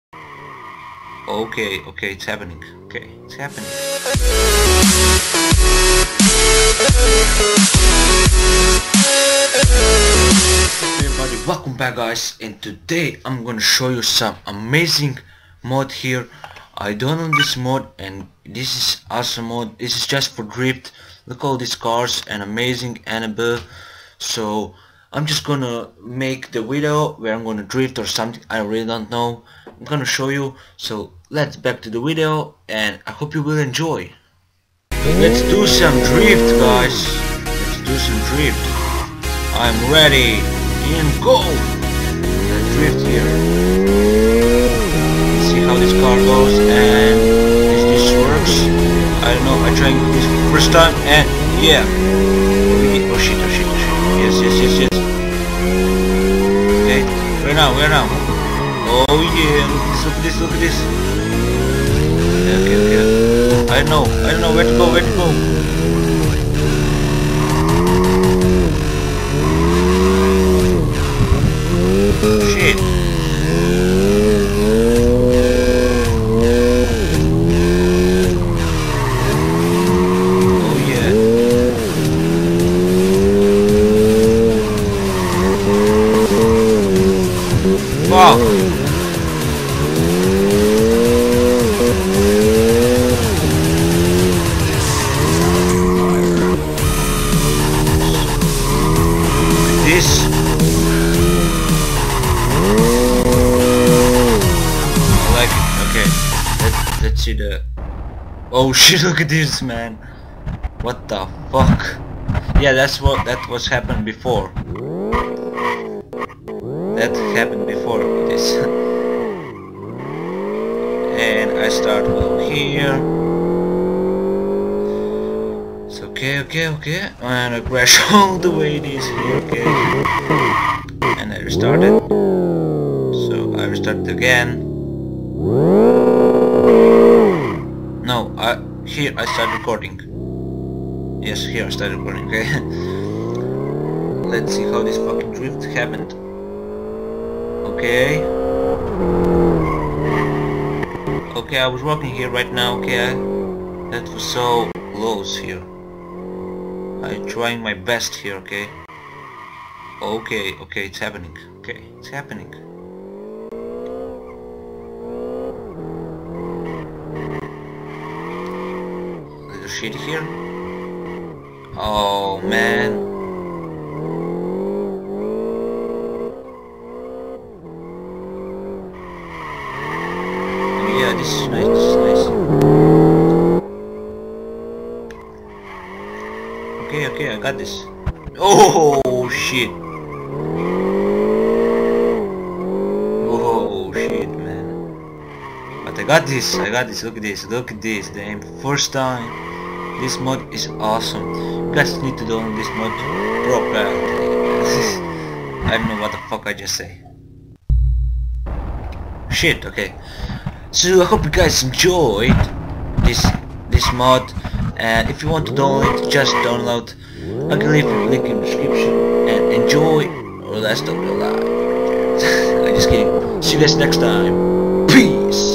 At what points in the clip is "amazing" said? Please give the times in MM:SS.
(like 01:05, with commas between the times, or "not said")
00:14, 00:22.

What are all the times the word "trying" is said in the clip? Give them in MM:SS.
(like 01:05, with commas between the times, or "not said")
00:49, 02:37.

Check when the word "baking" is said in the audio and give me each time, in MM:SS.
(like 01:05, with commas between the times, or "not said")
not said.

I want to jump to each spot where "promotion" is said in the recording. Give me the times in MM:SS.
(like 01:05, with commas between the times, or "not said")
not said.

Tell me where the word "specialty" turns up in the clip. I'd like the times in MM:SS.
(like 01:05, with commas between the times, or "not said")
not said.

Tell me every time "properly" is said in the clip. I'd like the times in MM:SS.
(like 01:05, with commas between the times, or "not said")
03:23.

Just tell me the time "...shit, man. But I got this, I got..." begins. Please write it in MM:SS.
03:13.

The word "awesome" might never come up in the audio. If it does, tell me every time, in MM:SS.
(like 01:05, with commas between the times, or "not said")
00:19, 03:20.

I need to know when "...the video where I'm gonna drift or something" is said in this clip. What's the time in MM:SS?
00:26.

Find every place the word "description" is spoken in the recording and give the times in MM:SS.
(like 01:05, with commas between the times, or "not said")
03:38.